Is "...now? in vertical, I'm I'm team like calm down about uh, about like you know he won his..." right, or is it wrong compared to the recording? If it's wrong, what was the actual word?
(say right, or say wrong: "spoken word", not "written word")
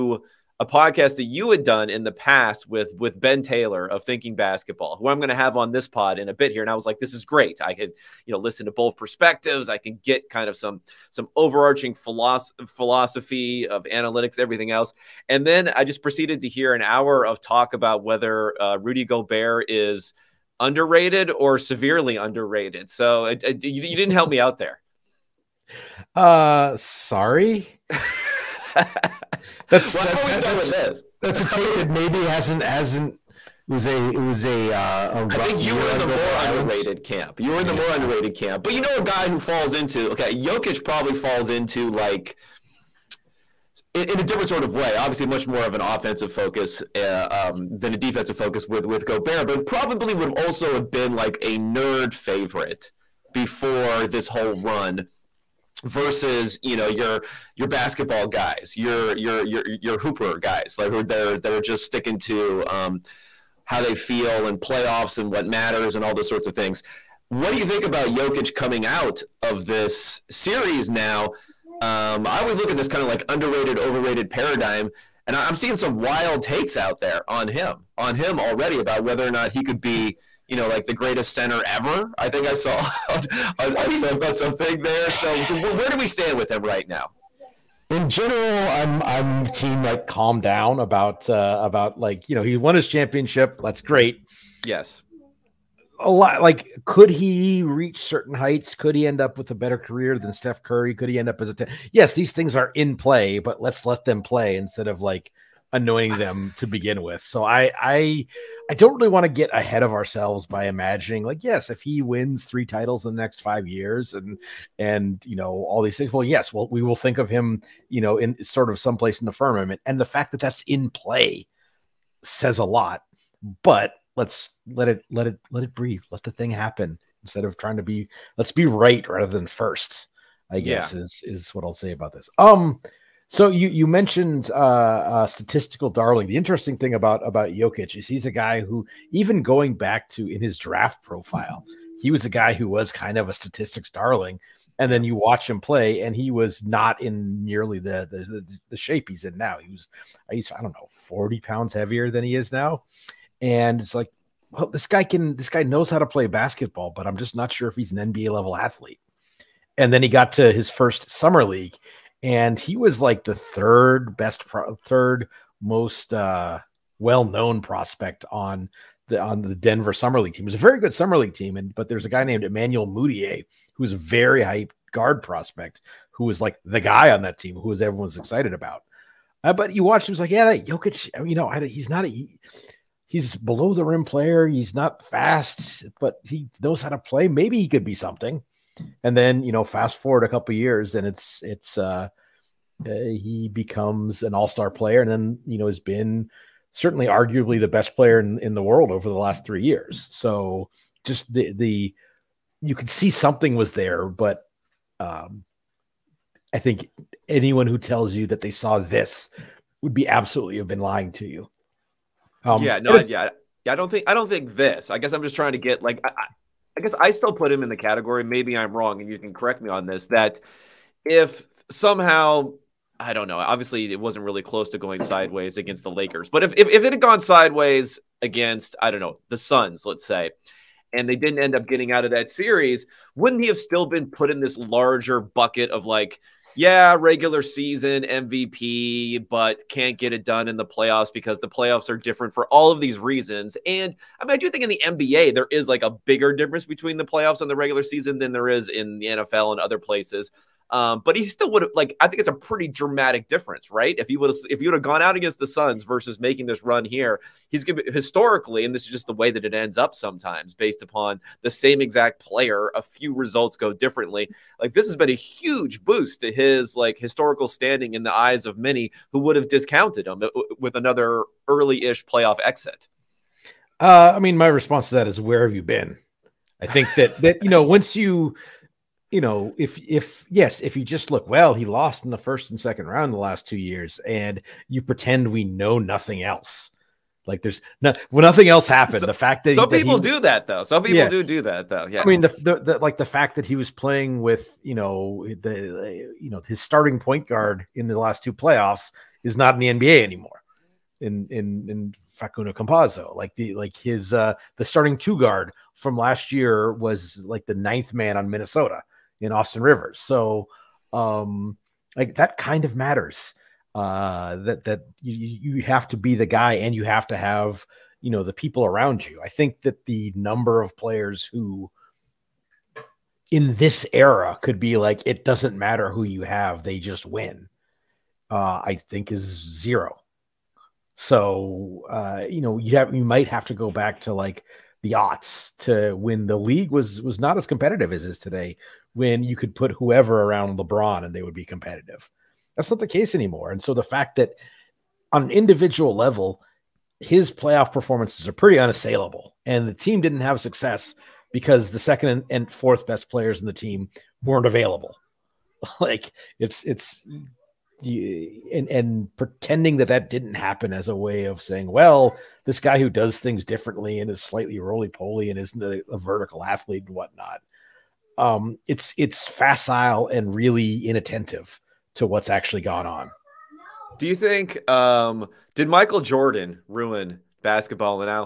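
wrong: "general", not "vertical".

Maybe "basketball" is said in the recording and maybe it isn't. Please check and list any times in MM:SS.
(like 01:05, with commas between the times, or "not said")
00:04, 00:57, 02:36, 06:17.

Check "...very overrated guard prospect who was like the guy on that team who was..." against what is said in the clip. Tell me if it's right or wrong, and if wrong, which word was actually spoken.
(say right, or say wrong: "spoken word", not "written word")
wrong: "hyped", not "overrated".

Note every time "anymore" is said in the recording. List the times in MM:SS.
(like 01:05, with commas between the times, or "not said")
05:00, 05:43.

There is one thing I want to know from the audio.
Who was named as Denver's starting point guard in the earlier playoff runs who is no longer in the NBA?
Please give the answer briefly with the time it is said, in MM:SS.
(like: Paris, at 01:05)
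Facundo Campazzo, at 05:02.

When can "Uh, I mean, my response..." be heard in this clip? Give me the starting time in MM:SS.
04:33.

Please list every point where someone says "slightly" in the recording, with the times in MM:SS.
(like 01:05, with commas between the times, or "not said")
06:04.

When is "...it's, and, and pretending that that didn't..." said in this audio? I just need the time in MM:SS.
05:56.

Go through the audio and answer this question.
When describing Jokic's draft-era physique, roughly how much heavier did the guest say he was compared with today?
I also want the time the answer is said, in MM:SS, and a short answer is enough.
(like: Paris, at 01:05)
40 pounds, at 02:30.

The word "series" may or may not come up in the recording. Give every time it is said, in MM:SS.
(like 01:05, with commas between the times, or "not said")
01:10, 03:52.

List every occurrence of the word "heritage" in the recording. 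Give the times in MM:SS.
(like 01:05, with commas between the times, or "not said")
not said.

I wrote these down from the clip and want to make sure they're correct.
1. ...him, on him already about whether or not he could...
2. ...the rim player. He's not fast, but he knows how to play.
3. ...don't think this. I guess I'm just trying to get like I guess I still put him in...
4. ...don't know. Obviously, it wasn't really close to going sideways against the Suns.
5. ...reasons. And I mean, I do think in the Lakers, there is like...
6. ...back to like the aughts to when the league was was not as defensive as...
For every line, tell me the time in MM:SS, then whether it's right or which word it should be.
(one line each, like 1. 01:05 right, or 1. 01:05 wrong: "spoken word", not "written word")
1. 01:17 right
2. 03:03 right
3. 03:34 right
4. 03:43 wrong: "Lakers", not "Suns"
5. 04:02 wrong: "NBA", not "Lakers"
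6. 05:33 wrong: "competitive", not "defensive".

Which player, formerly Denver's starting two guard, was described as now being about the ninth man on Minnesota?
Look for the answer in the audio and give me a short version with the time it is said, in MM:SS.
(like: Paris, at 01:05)
Austin Rivers, at 05:09.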